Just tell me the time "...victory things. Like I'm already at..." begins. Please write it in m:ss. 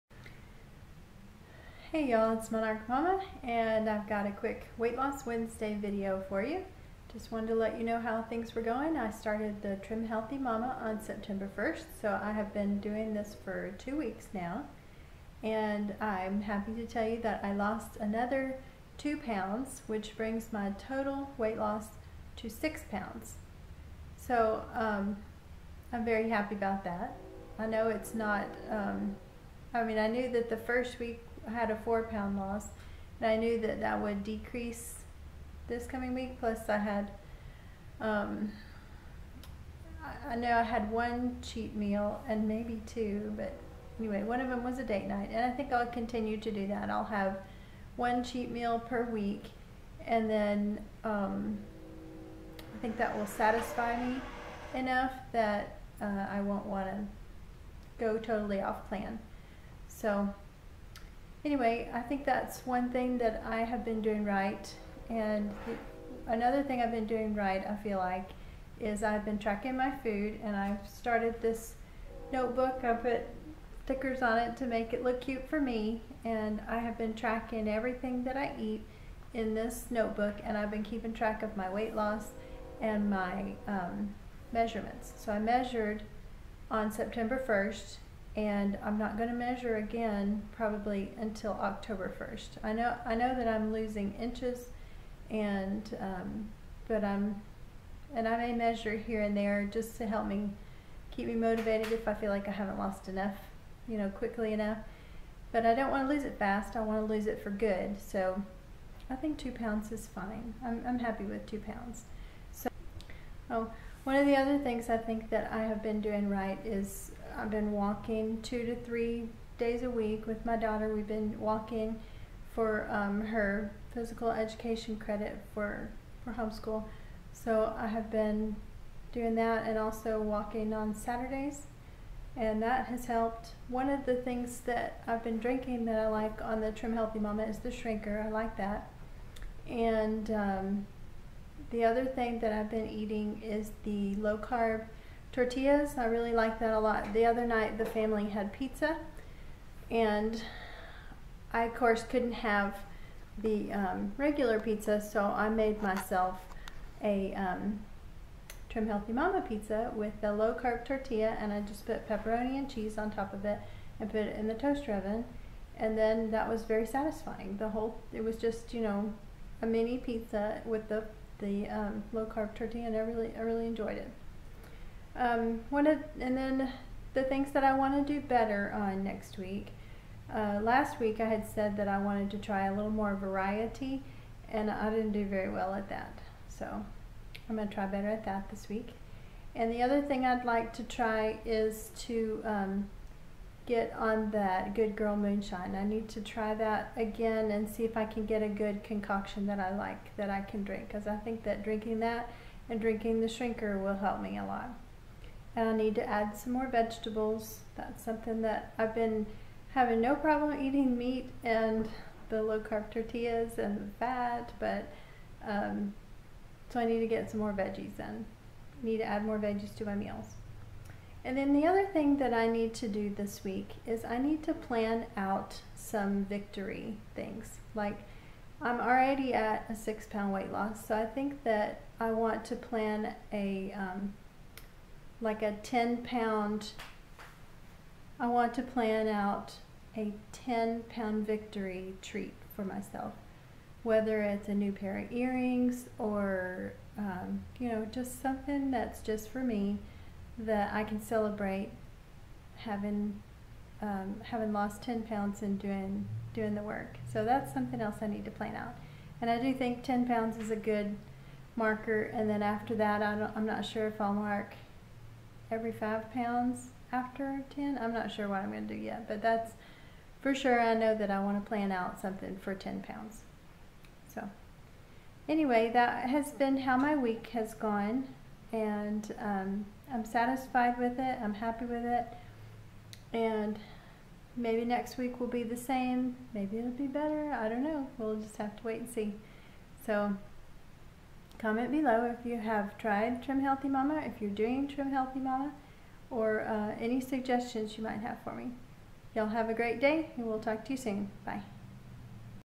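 3:46.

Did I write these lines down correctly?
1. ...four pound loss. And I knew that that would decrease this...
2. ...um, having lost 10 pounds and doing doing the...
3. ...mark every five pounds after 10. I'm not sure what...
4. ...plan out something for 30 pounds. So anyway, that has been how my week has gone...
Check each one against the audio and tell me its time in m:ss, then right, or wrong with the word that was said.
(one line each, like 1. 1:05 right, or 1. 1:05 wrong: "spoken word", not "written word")
1. 0:31 right
2. 4:13 right
3. 4:24 right
4. 4:31 wrong: "10", not "30".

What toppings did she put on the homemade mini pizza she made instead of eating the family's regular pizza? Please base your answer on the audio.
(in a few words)
Pepperoni and cheese.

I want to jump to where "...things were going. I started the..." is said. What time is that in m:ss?
0:08.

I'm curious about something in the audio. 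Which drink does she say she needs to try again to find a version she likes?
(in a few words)
Good Girl Moonshine.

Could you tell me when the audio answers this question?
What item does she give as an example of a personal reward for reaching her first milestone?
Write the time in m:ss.
4:05.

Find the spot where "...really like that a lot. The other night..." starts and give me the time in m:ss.
2:26.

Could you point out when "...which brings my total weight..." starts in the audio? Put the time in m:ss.
0:19.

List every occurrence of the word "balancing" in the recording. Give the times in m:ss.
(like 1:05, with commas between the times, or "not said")
not said.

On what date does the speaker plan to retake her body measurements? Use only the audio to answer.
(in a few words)
October 1st.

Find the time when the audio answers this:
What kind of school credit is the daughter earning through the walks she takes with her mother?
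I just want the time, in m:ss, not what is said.
2:03.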